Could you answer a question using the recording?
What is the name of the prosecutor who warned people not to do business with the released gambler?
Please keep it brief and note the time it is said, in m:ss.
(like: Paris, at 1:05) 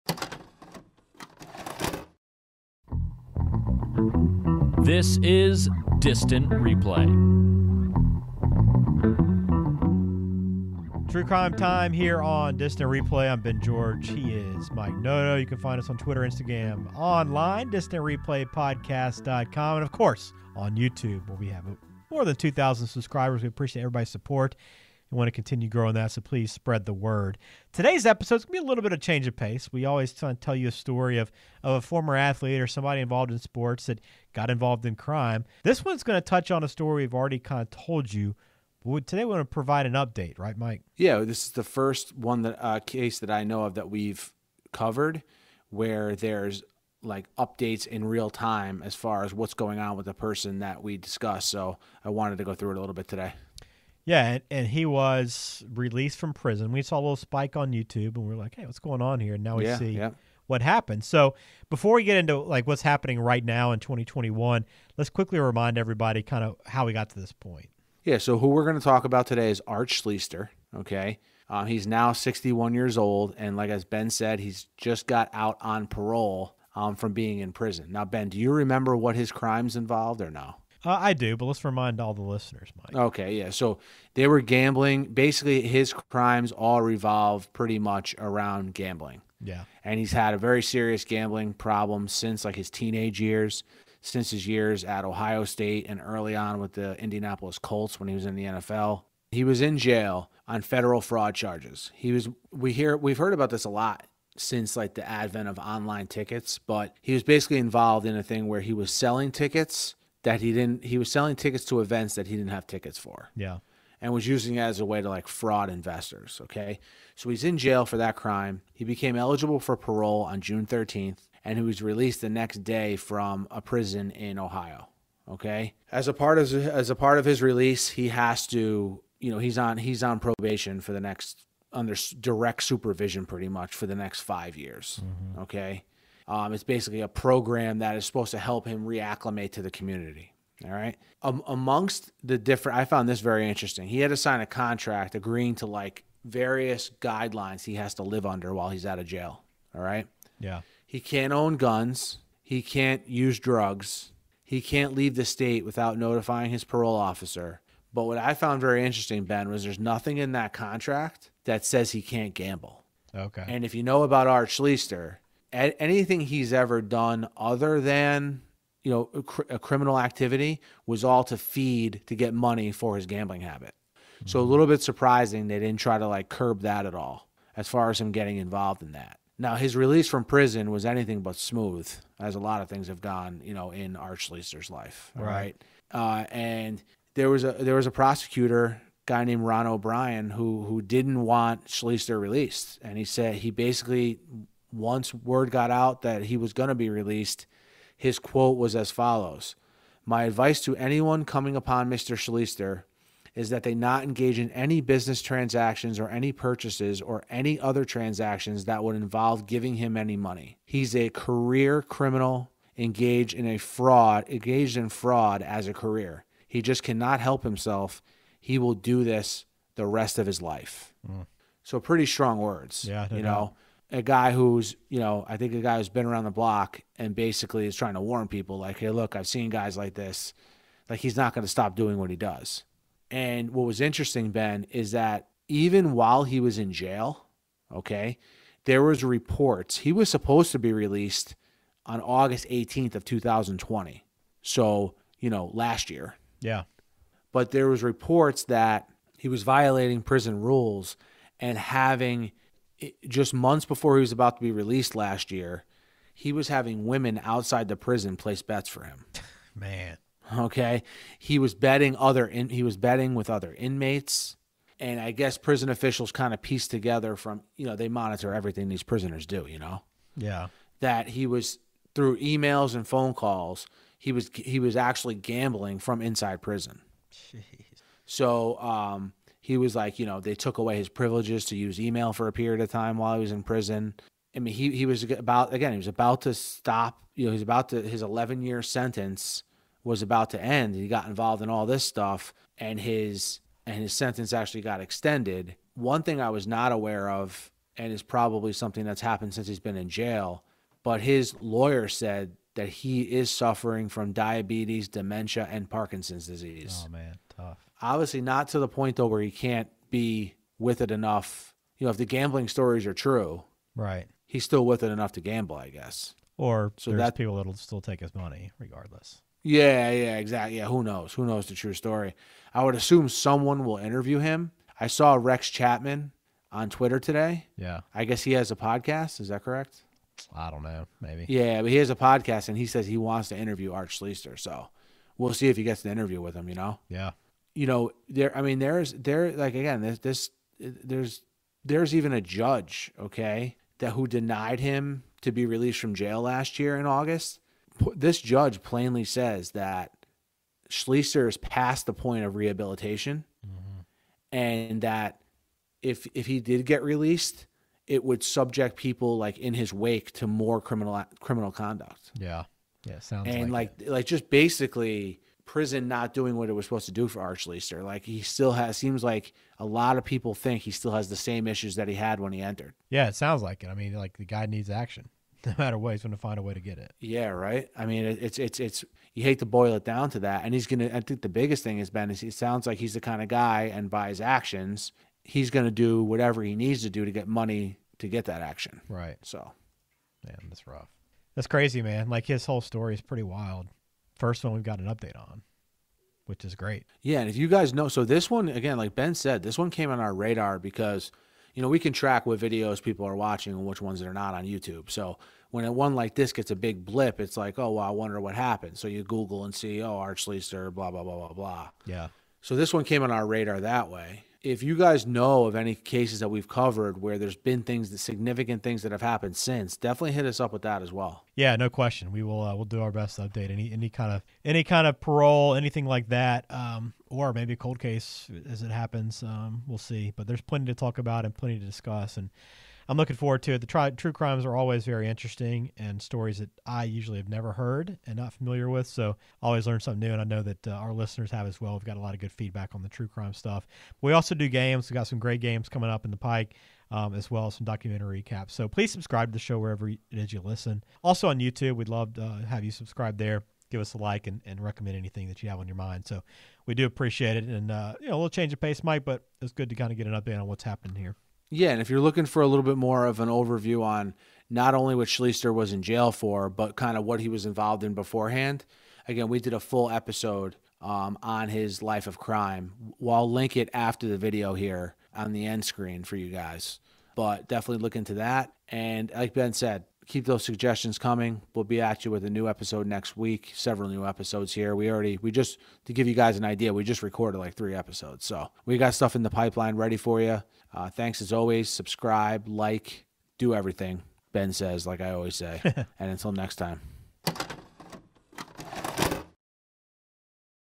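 Ron O'Brien, at 3:09.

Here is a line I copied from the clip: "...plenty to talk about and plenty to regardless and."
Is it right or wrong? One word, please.
wrong.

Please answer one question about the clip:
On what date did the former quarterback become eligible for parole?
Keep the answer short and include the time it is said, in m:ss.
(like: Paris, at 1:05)
June 13, at 2:00.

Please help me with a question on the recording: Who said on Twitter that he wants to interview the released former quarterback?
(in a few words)
Rex Chapman.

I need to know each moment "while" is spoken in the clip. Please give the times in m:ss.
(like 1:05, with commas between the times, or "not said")
2:28, 3:55, 4:42.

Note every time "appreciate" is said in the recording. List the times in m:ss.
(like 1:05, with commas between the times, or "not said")
0:23, 7:36.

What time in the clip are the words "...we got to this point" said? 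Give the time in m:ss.
1:06.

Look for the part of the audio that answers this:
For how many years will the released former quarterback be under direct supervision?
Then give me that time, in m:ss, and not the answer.
2:14.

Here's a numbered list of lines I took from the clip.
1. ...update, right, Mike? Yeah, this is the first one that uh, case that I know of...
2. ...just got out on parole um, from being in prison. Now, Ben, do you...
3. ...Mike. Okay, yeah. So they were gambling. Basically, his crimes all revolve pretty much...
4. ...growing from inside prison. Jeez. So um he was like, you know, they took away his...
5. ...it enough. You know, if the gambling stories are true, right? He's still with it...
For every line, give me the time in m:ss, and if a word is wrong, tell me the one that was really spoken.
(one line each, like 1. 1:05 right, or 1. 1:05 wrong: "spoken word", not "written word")
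1. 0:39 right
2. 1:14 right
3. 1:22 right
4. 4:35 wrong: "gambling", not "growing"
5. 5:10 right.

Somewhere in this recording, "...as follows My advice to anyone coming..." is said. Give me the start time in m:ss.
3:18.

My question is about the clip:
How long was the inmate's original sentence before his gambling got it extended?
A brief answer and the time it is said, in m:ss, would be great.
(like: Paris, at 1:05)
11 years, at 4:48.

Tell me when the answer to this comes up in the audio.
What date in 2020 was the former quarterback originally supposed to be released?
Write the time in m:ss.
4:01.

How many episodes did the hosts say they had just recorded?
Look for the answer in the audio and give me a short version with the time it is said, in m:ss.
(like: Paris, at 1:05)
3, at 8:07.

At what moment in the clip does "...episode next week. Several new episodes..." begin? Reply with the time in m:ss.
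8:02.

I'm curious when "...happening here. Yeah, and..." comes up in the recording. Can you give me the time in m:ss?
7:40.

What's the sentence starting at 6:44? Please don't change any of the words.
So when a one like this gets a big blip, it's like, oh, well, I wonder what happened.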